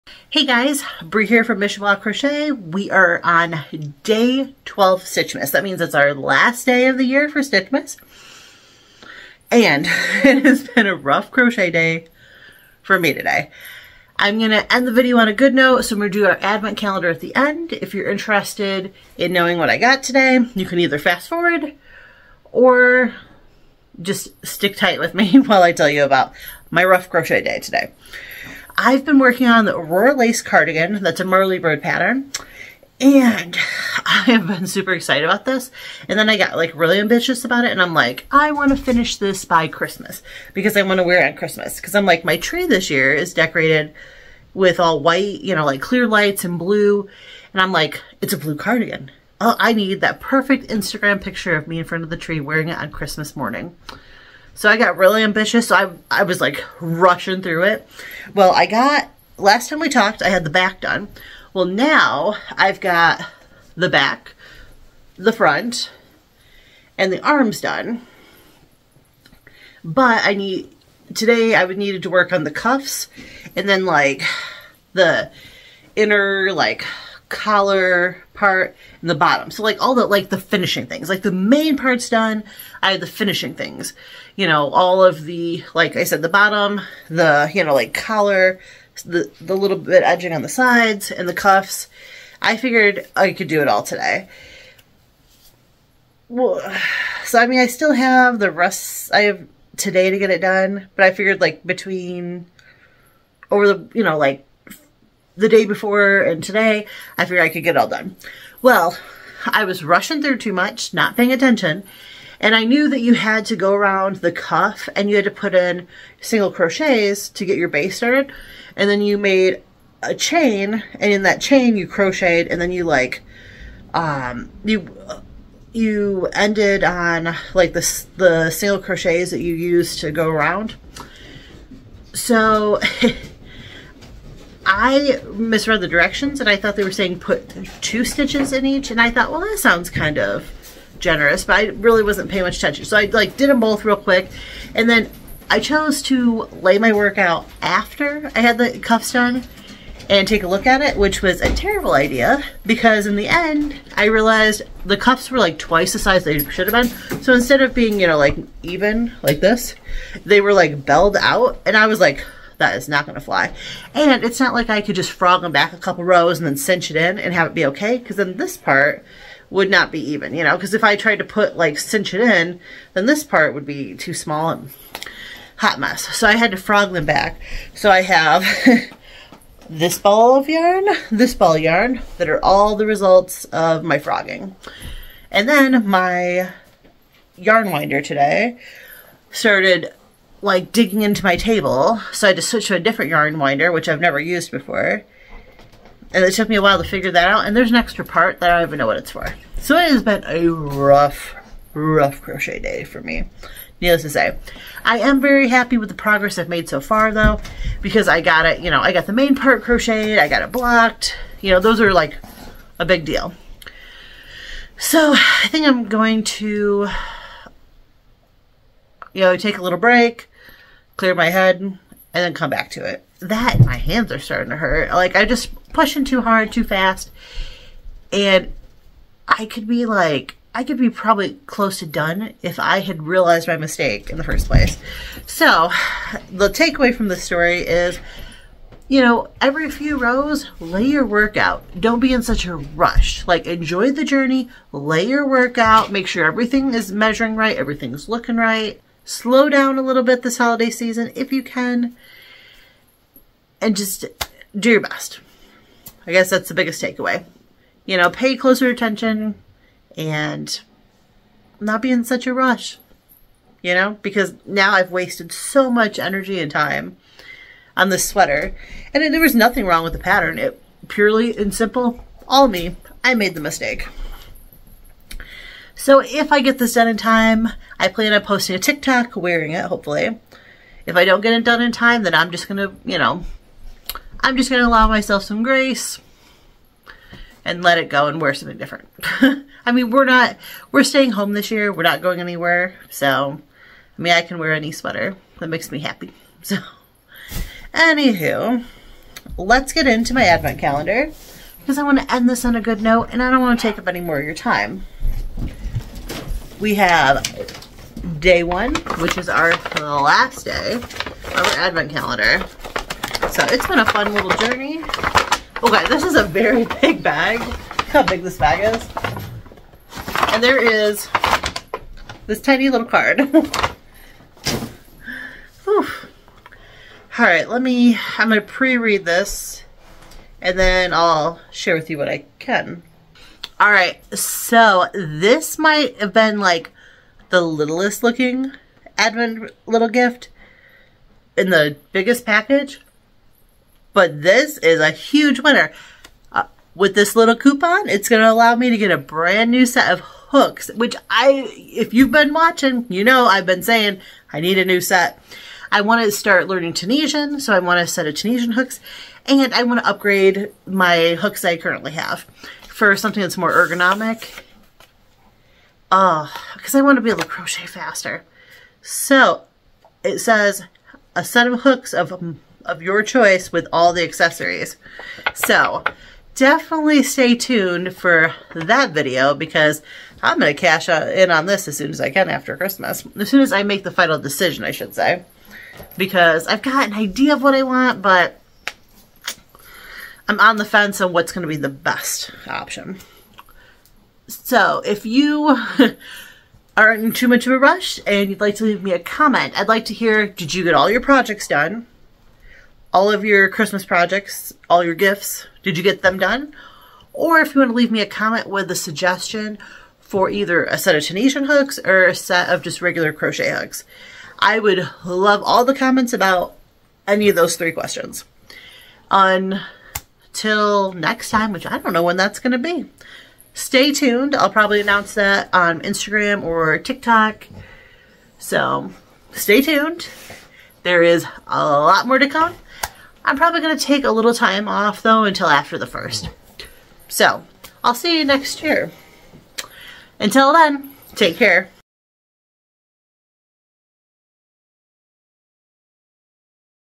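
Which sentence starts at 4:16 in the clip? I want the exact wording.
I guess that's the biggest takeaway.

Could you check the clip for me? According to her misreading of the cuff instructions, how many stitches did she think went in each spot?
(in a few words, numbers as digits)
2.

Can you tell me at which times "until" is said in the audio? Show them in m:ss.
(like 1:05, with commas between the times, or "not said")
7:15, 7:20.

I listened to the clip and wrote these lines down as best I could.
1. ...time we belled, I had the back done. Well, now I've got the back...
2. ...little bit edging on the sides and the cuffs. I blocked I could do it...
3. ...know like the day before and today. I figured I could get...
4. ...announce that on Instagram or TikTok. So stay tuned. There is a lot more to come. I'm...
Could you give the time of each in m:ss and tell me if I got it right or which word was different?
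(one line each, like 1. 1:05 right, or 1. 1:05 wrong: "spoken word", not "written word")
1. 0:59 wrong: "talked", not "belled"
2. 1:29 wrong: "figured", not "blocked"
3. 1:44 right
4. 7:04 right.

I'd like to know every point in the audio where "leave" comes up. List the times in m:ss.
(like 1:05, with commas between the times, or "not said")
6:38, 6:47.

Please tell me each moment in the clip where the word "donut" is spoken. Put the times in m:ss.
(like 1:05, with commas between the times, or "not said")
not said.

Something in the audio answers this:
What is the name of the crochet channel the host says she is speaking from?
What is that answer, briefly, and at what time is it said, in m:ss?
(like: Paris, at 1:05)
Michowa Crochet, at 0:01.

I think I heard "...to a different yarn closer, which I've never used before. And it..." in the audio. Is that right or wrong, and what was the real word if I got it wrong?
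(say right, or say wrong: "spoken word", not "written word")
wrong: "winder", not "closer".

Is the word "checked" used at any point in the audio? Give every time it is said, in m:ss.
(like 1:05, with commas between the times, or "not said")
not said.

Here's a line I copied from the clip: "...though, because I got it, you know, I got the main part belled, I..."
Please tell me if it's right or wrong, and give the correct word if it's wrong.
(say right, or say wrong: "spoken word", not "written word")
wrong: "crocheted", not "belled".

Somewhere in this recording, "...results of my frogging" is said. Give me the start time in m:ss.
3:02.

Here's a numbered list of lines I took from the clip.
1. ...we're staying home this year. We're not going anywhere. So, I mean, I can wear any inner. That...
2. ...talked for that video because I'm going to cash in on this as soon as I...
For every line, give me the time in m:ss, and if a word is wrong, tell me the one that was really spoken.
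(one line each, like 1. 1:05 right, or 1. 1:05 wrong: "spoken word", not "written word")
1. 4:50 wrong: "sweater", not "inner"
2. 6:17 wrong: "tuned", not "talked".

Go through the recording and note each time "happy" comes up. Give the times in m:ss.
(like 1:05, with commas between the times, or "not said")
3:25, 4:55.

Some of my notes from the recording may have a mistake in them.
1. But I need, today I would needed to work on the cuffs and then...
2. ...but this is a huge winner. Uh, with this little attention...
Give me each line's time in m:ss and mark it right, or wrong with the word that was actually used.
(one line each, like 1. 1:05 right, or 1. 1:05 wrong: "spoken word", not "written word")
1. 1:09 right
2. 5:43 wrong: "coupon", not "attention".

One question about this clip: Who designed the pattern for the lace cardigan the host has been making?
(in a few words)
Merly Bird.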